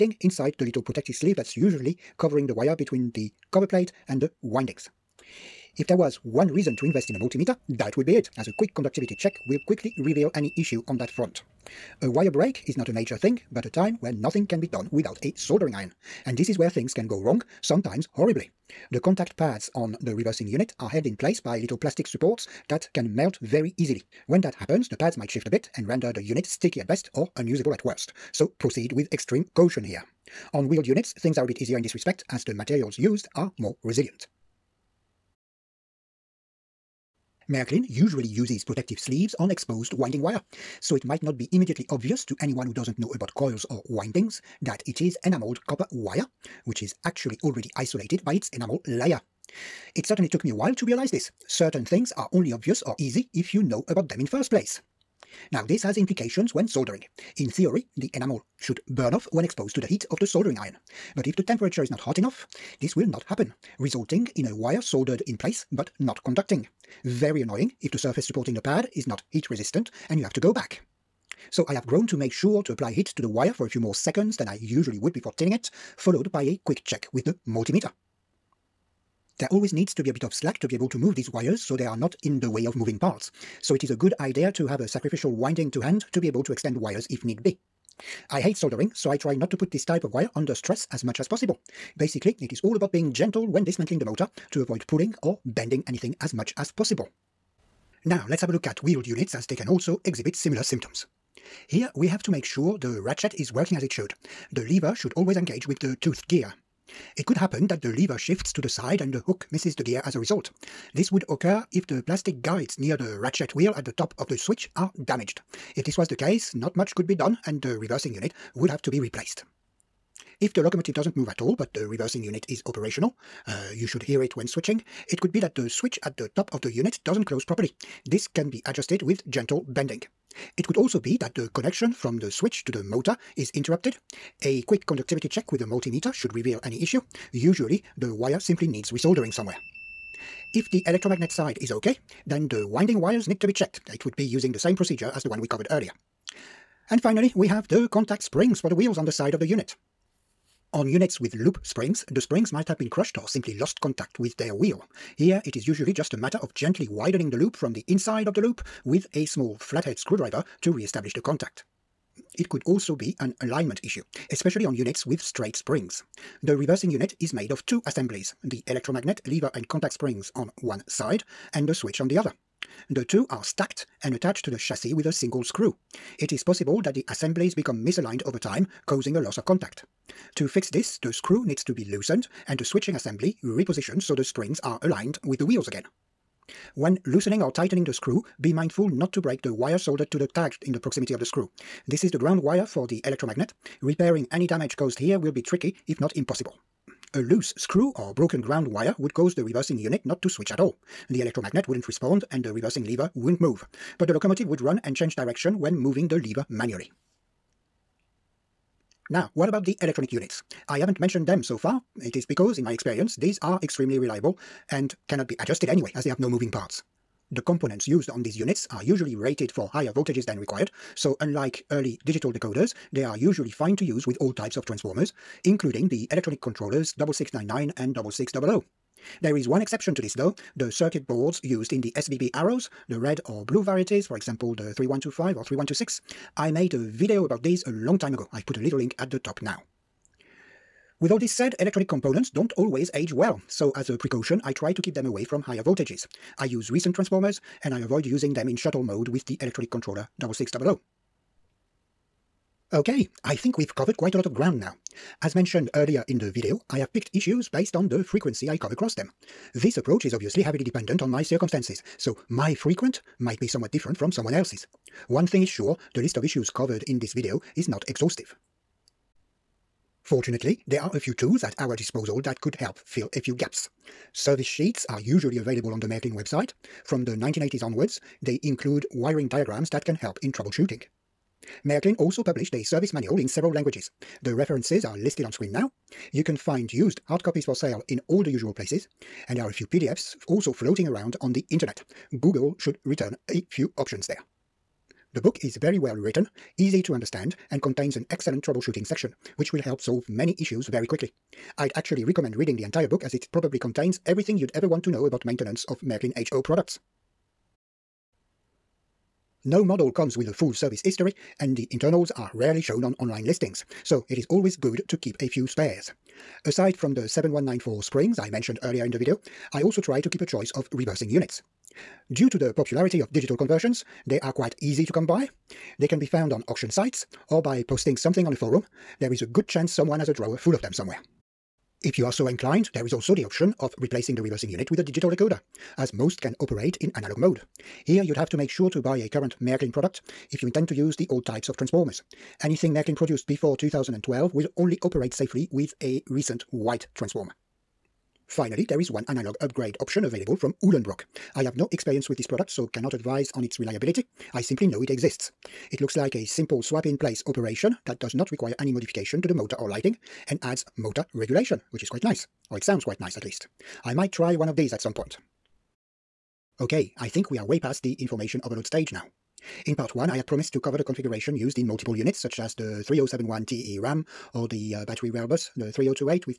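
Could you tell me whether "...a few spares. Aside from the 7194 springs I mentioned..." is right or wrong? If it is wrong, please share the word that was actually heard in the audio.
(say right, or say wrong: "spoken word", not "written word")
right.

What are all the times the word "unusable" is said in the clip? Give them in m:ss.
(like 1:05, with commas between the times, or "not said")
0:27.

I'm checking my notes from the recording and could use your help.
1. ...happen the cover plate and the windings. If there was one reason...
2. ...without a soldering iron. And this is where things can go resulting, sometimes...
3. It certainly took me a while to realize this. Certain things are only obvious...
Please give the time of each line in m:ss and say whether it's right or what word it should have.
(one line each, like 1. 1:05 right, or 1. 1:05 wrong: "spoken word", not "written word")
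1. 0:02 wrong: "between", not "happen"
2. 0:14 wrong: "wrong", not "resulting"
3. 0:49 right.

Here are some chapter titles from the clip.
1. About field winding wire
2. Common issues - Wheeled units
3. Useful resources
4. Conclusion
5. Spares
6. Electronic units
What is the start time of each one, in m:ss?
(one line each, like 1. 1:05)
1. 0:34
2. 1:37
3. 4:29
4. 6:05
5. 5:07
6. 3:27.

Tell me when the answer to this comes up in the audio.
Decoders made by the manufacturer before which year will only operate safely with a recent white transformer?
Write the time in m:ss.
5:43.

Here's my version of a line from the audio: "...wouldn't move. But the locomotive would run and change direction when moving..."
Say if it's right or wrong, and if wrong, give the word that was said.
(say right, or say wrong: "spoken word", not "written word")
right.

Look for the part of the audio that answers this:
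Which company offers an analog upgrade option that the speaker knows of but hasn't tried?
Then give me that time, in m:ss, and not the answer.
5:50.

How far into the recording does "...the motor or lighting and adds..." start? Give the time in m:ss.
5:59.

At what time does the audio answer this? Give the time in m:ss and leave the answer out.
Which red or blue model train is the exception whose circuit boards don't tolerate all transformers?
3:51.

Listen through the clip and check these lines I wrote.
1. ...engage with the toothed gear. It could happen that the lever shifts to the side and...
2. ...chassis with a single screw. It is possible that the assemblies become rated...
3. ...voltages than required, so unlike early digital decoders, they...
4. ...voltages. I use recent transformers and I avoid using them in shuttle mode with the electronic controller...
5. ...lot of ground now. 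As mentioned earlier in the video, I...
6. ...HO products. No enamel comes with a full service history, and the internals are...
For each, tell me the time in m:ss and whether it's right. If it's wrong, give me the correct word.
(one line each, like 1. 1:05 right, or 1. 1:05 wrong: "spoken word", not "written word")
1. 1:45 right
2. 2:54 wrong: "misaligned", not "rated"
3. 3:39 right
4. 4:05 right
5. 4:14 right
6. 5:06 wrong: "model", not "enamel".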